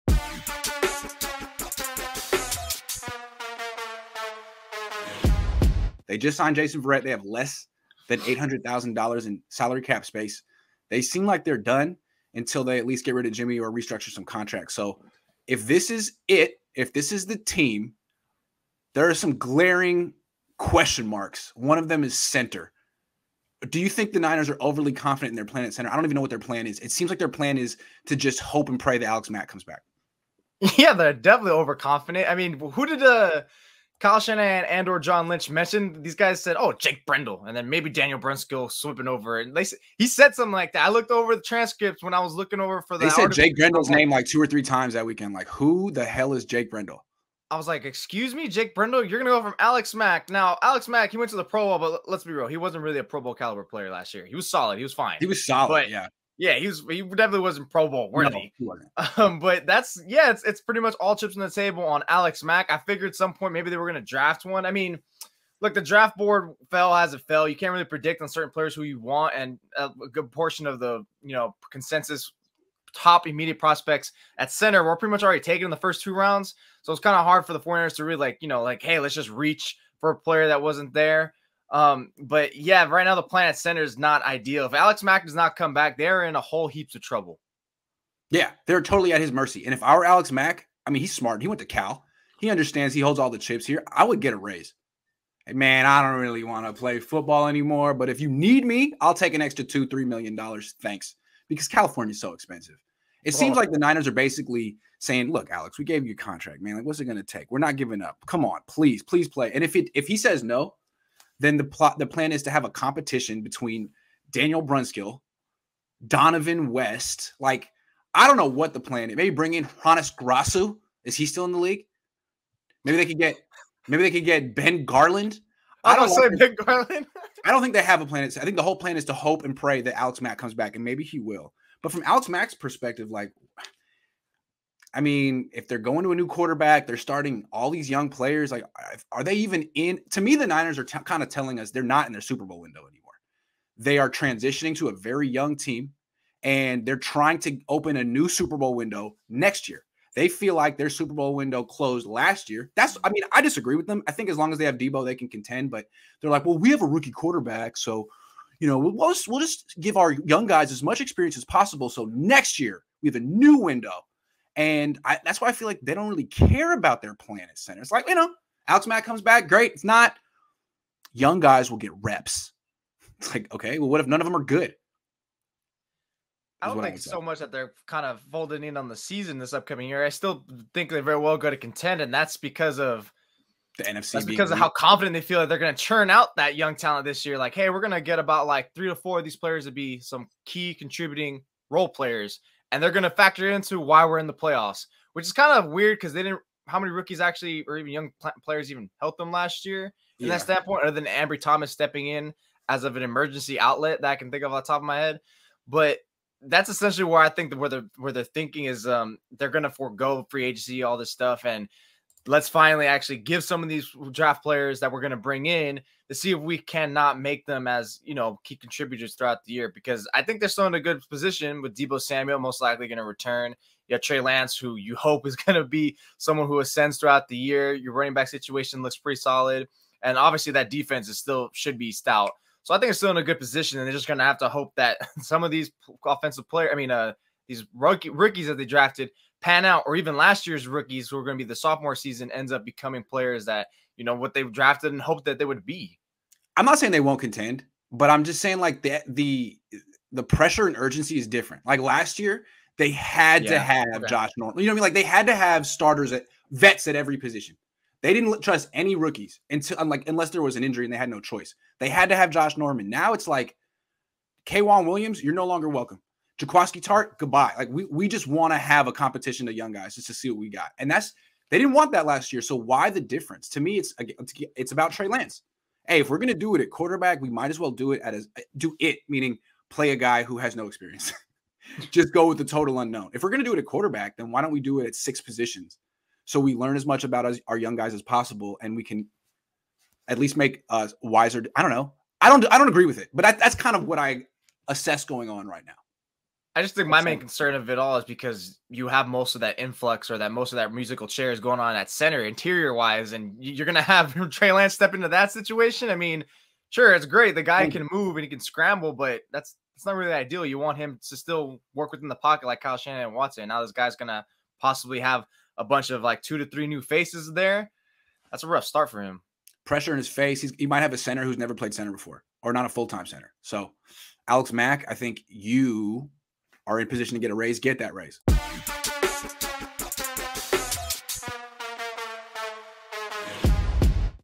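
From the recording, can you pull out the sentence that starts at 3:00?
I still think they very well go to contend, and that's because of the NFC.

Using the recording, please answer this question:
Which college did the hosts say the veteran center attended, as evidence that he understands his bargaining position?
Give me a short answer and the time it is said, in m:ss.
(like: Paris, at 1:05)
Cal, at 1:31.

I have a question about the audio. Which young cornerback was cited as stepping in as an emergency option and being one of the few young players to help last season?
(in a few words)
Ambry Thomas.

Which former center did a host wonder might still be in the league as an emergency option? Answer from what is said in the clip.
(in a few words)
Hroniss Grasu.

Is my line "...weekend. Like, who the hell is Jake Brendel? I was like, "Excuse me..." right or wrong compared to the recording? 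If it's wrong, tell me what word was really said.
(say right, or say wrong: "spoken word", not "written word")
right.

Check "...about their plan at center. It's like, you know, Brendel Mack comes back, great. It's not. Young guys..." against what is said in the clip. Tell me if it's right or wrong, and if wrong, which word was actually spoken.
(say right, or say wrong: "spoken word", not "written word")
wrong: "Alex", not "Brendel".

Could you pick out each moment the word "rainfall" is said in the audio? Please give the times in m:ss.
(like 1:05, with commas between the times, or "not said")
not said.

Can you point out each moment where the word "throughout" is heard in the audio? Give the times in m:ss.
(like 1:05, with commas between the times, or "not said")
3:39, 3:46.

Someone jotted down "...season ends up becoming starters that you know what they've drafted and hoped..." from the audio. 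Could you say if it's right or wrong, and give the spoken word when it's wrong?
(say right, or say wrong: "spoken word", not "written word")
wrong: "players", not "starters".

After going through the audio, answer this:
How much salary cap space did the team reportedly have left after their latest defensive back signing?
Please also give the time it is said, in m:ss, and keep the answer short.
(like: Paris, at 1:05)
Less than $800,000, at 0:07.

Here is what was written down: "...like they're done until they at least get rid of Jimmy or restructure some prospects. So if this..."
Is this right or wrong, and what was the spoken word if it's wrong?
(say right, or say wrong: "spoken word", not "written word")
wrong: "contracts", not "prospects".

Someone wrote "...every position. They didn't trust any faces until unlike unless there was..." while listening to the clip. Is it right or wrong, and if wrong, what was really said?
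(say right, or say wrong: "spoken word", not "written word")
wrong: "rookies", not "faces".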